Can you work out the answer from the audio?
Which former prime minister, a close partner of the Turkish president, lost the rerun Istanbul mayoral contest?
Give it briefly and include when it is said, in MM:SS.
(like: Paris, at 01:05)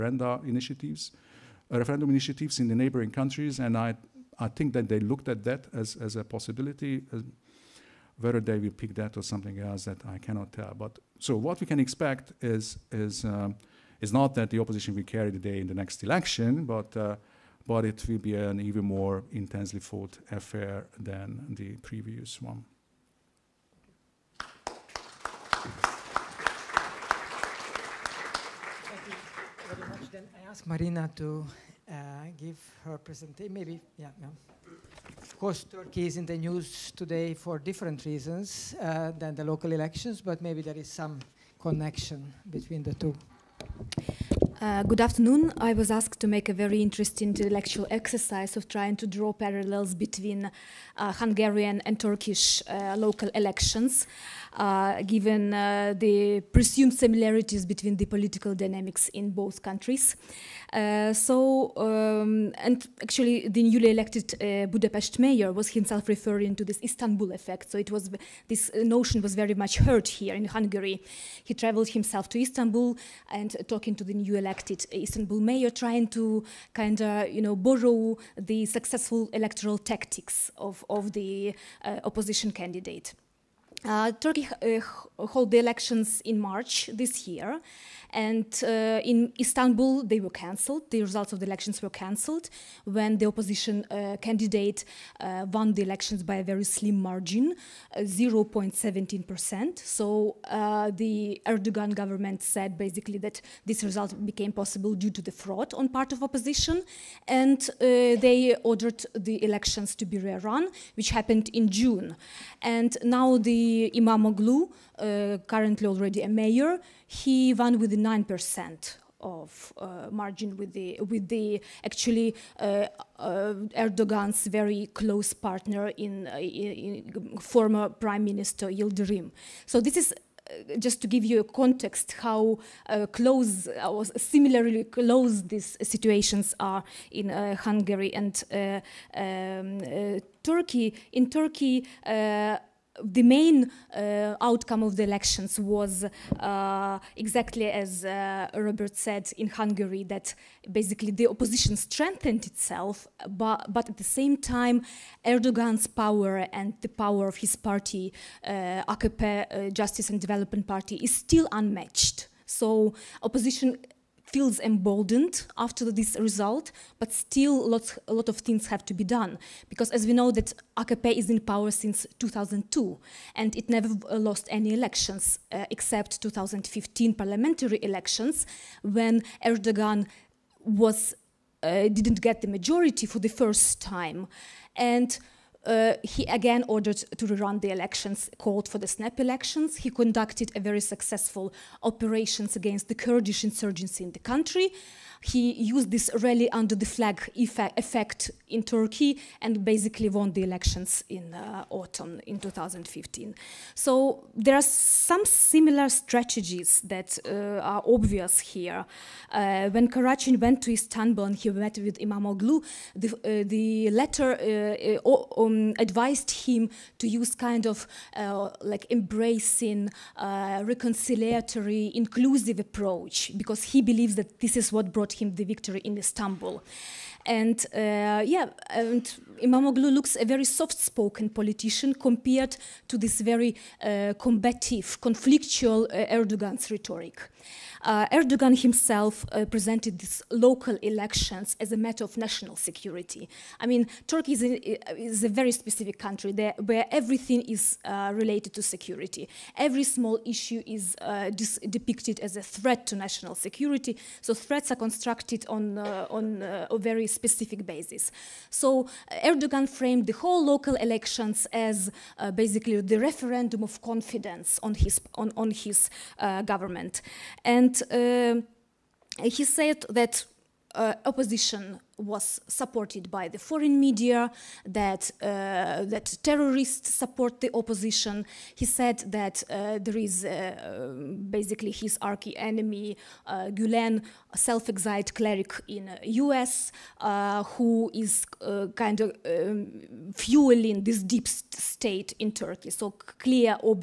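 Yildirim, at 02:08.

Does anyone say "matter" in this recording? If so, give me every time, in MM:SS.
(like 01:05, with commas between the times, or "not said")
04:01.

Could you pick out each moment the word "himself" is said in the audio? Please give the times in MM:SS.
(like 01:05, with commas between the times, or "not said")
01:05, 01:11, 03:58.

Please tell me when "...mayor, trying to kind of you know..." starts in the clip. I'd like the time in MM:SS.
01:15.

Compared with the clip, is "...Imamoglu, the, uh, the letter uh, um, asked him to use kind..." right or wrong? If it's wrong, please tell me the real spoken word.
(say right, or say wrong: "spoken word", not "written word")
wrong: "advised", not "asked".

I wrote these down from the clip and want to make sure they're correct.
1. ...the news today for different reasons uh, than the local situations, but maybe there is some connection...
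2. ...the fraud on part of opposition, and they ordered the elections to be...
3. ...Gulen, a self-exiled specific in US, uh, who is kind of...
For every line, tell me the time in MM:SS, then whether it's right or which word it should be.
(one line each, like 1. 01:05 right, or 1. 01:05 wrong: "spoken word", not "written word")
1. 00:36 wrong: "elections", not "situations"
2. 01:45 right
3. 04:43 wrong: "cleric", not "specific".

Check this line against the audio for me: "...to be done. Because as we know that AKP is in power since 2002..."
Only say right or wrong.
right.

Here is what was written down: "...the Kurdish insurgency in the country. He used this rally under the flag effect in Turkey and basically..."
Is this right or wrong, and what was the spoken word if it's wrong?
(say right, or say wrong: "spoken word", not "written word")
right.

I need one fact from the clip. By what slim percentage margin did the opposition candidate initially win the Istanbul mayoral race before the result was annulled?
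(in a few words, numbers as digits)
0.17 percent.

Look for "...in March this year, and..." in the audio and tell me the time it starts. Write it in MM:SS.
01:26.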